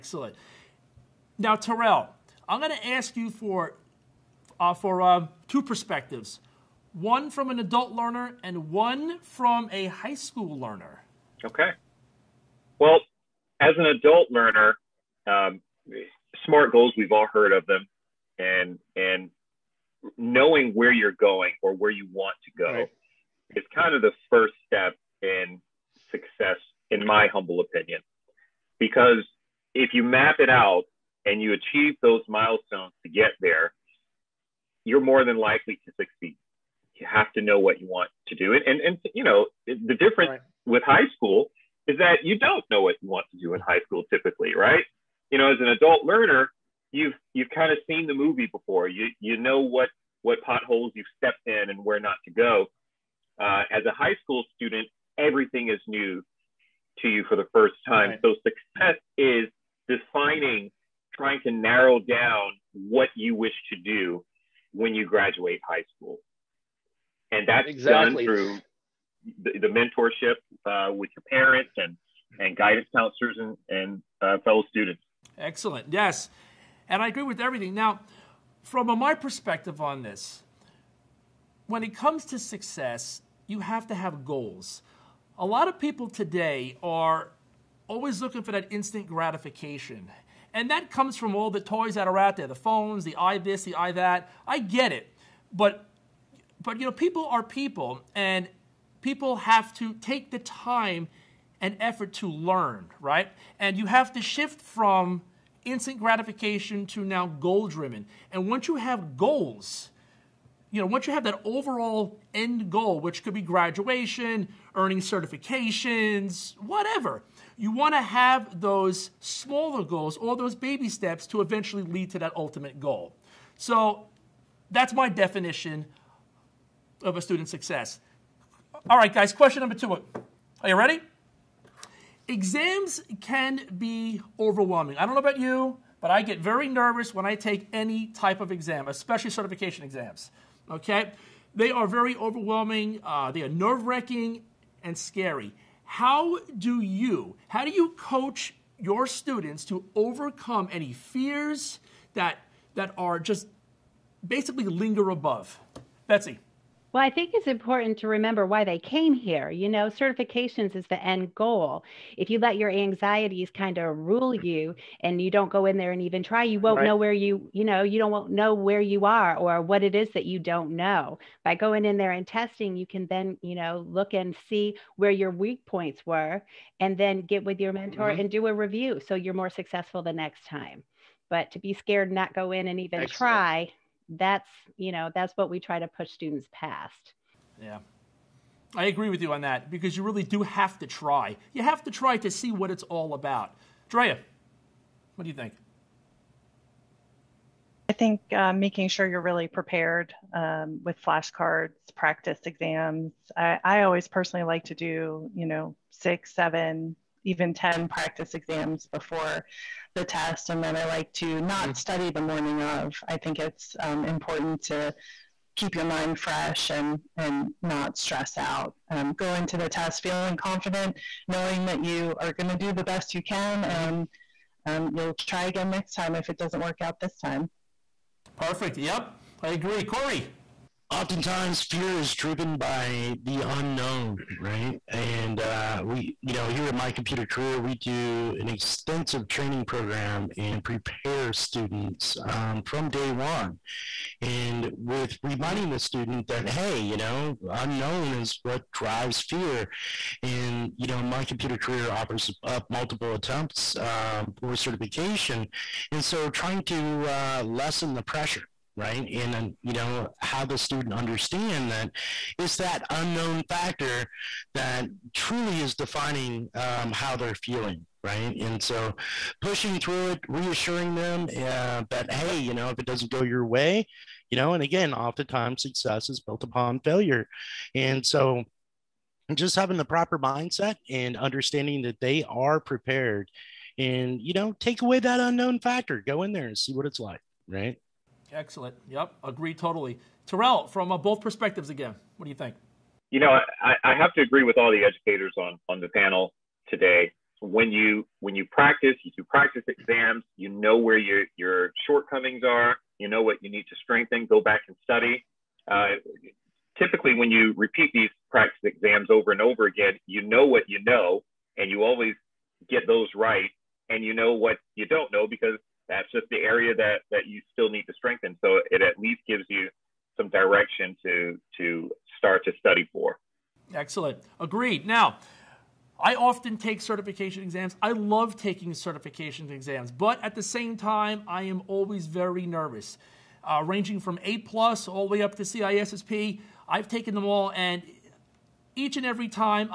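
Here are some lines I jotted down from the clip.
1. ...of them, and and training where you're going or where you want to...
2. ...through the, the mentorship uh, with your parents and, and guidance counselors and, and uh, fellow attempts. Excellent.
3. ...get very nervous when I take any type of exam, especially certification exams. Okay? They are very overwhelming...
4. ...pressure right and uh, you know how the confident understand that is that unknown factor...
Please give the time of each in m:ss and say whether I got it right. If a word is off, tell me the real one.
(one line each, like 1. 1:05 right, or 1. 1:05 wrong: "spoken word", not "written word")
1. 0:17 wrong: "knowing", not "training"
2. 1:08 wrong: "students", not "attempts"
3. 2:16 right
4. 4:18 wrong: "student", not "confident".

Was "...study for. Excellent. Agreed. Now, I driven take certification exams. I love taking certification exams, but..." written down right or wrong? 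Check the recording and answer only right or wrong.
wrong.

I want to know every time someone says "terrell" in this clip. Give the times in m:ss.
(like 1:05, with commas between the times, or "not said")
0:01, 4:50.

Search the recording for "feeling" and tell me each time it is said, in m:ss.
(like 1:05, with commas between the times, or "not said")
3:40, 4:27.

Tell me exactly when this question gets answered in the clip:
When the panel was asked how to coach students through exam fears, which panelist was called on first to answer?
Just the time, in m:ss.
2:36.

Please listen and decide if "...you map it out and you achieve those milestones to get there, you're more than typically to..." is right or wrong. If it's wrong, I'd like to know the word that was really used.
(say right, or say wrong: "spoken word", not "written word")
wrong: "likely", not "typically".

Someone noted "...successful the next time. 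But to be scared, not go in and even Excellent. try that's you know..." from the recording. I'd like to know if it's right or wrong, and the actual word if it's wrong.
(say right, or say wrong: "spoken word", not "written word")
right.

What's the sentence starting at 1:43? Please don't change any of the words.
And you have to shift from instant gratification to now goal driven.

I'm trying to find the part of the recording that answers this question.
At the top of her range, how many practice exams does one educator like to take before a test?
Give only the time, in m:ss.
3:27.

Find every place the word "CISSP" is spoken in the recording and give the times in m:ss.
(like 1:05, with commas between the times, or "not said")
5:35.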